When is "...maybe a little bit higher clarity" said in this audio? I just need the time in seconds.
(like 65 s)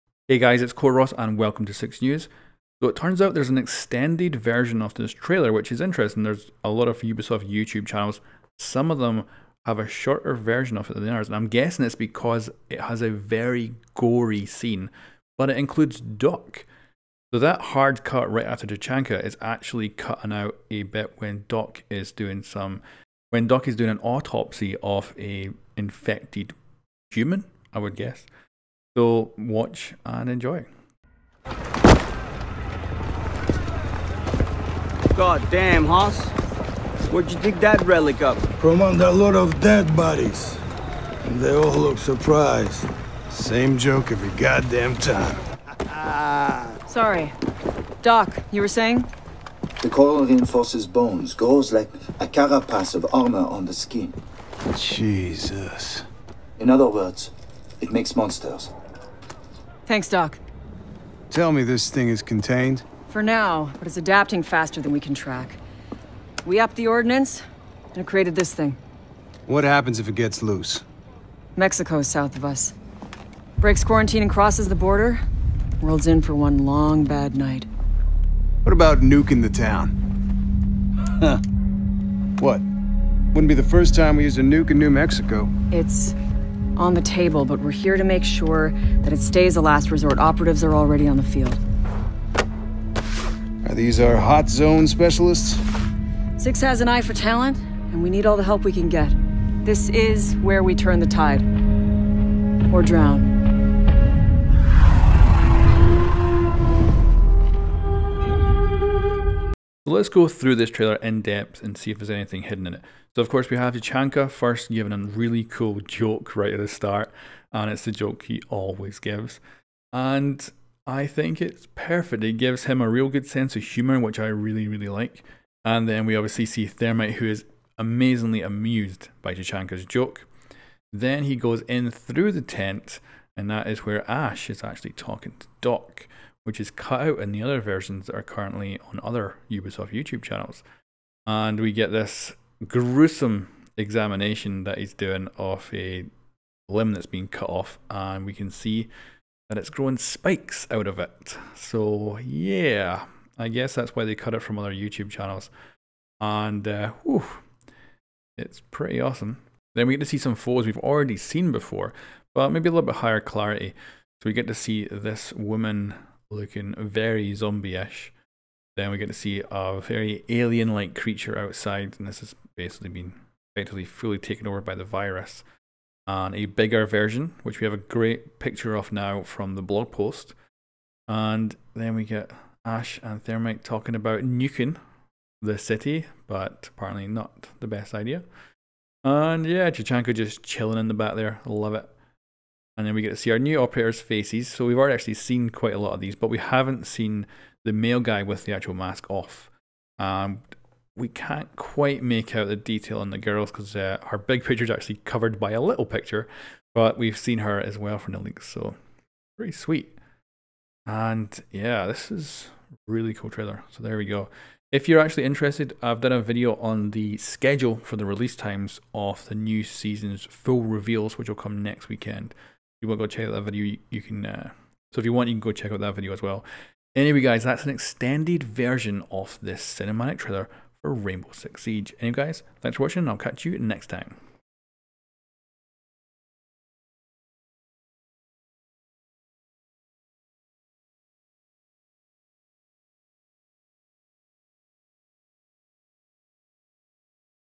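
162 s.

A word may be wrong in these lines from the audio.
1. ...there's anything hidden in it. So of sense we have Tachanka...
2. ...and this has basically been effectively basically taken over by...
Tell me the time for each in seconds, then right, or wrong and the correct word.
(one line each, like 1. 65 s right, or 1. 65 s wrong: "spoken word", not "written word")
1. 111 s wrong: "course", not "sense"
2. 171 s wrong: "fully", not "basically".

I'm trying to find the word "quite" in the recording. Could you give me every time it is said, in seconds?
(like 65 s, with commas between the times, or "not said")
195 s, 201 s.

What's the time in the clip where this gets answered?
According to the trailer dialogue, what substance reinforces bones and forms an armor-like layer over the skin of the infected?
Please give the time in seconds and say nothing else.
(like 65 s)
49 s.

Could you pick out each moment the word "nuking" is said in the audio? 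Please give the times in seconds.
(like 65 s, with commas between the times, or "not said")
79 s, 184 s.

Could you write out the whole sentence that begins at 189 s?
And yeah, Tachanka just chilling in the back there.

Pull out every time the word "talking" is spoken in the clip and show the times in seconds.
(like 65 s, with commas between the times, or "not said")
134 s, 183 s.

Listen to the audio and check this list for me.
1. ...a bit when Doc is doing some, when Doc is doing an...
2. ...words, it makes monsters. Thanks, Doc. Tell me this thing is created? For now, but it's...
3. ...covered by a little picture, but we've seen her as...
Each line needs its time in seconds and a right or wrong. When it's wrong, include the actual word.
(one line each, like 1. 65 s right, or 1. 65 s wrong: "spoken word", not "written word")
1. 20 s right
2. 56 s wrong: "contained", not "created"
3. 205 s right.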